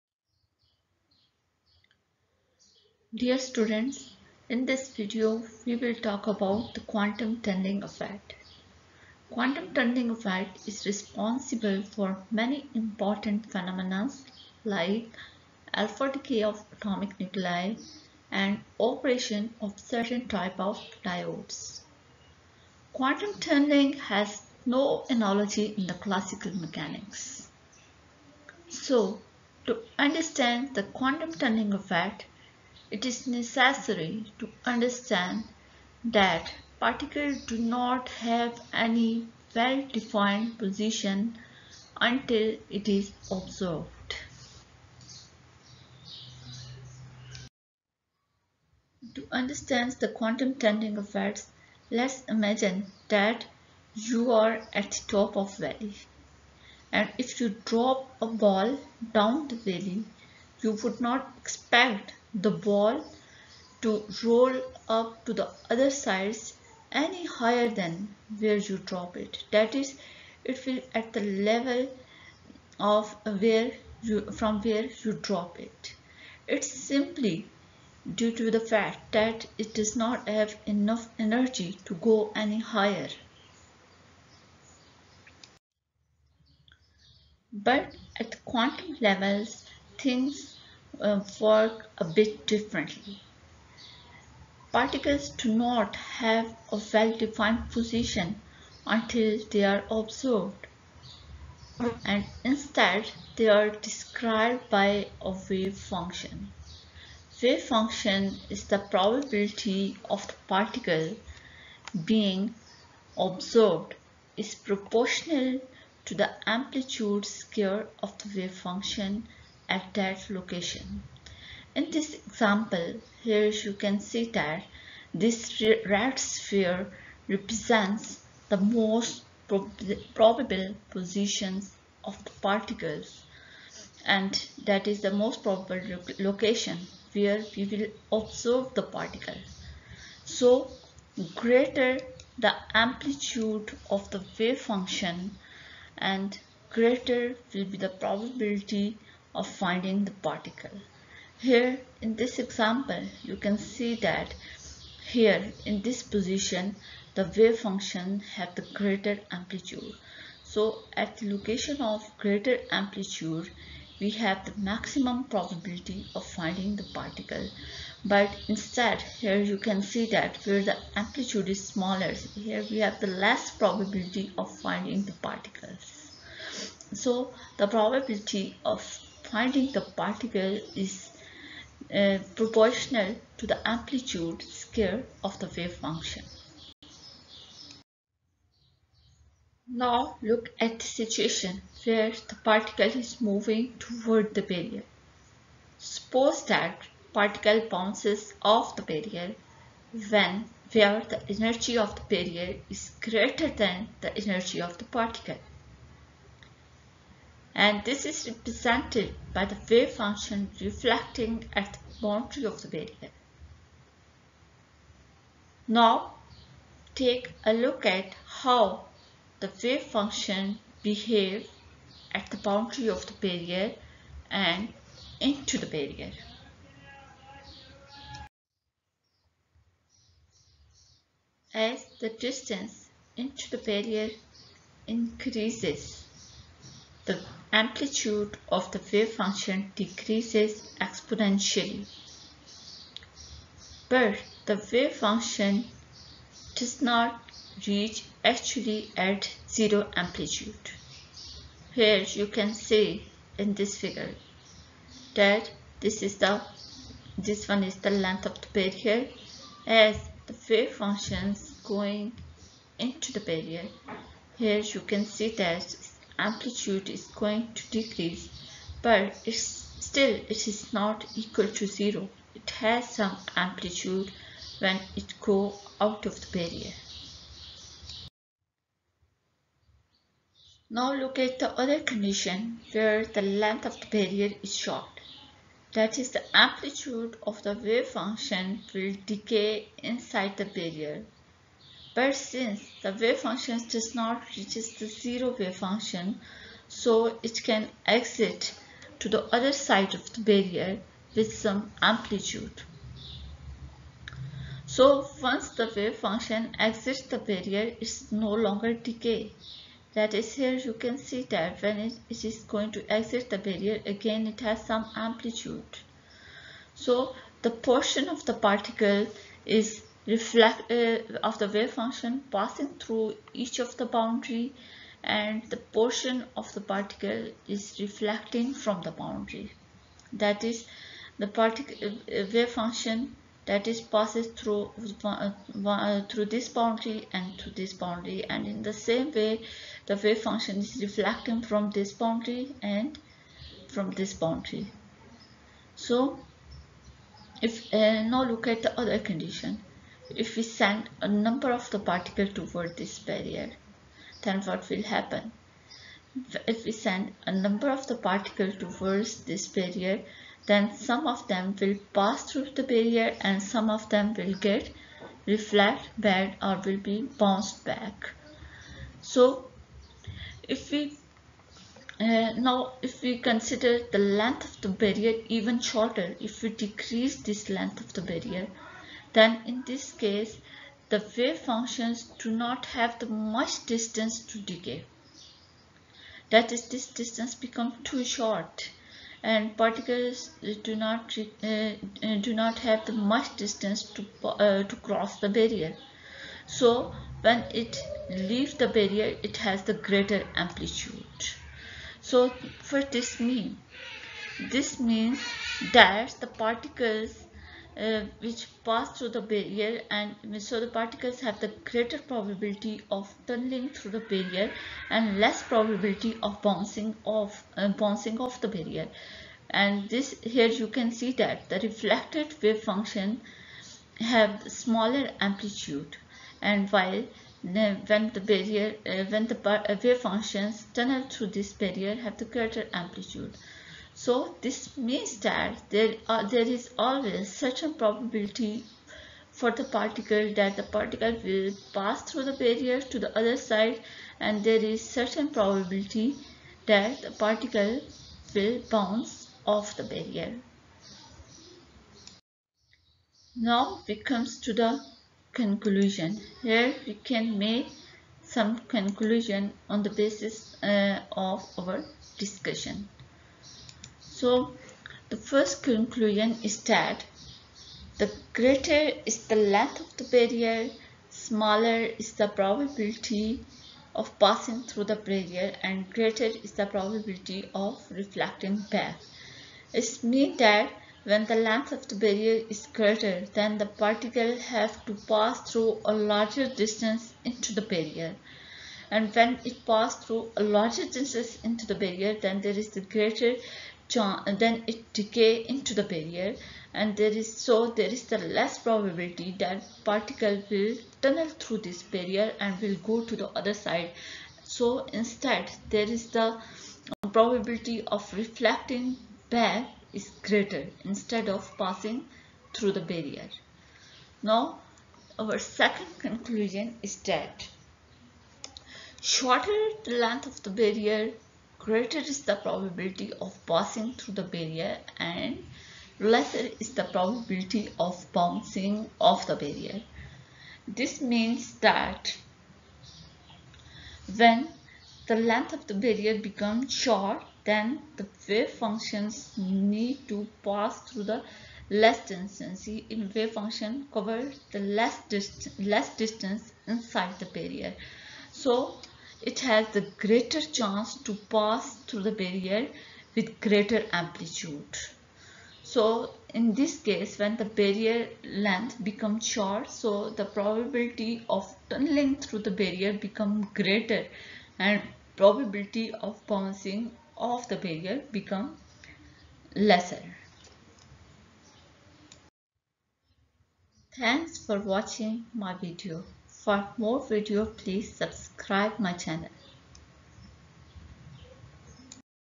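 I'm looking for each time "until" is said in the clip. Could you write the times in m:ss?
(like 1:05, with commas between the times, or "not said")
0:42, 1:38.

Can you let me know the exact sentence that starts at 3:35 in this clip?
Now take a look at how the wave function behave at the boundary of the barrier and into the barrier.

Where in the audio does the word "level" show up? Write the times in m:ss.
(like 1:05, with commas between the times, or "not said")
1:11, 1:29.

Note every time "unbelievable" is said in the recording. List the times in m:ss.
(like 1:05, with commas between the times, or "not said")
not said.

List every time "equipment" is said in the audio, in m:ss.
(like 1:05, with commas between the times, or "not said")
not said.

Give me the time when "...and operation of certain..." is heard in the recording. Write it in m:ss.
0:18.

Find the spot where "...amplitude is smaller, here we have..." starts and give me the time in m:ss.
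2:50.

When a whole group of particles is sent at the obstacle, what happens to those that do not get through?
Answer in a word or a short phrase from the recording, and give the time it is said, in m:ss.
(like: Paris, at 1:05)
bounced back, at 6:07.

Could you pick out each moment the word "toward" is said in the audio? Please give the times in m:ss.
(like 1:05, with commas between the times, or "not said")
3:13, 5:52, 5:58.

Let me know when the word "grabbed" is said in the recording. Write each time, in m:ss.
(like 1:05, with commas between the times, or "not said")
not said.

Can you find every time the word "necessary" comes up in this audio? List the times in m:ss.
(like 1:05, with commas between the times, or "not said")
0:33.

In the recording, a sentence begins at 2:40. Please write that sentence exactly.
So at the location of greater amplitude, we have the maximum probability of finding the particle.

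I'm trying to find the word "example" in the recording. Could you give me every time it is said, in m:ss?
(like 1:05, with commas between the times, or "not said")
2:02, 2:32.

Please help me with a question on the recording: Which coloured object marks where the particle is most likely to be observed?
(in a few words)
red sphere.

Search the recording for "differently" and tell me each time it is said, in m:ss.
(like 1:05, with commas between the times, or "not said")
1:32.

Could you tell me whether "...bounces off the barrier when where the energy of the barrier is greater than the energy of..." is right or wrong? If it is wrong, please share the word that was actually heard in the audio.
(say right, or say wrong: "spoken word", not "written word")
right.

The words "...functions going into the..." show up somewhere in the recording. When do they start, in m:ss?
4:20.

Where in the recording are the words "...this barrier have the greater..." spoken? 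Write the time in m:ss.
7:11.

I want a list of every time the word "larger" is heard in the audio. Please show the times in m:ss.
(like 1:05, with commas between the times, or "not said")
8:05, 8:10.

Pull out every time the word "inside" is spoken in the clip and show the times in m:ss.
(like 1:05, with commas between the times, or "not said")
4:49, 9:06.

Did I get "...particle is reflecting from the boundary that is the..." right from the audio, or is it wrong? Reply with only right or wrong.
right.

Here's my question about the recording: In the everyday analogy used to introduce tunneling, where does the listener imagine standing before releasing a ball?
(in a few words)
top of valley.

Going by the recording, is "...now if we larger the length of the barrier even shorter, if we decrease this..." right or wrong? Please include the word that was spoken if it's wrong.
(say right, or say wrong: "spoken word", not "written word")
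wrong: "consider", not "larger".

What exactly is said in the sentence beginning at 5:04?
So once the wave function exits the barrier, it's no longer decay.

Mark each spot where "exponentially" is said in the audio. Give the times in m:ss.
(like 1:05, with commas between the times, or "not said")
4:00.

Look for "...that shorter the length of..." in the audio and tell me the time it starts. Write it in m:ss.
8:37.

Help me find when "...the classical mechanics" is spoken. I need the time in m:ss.
0:25.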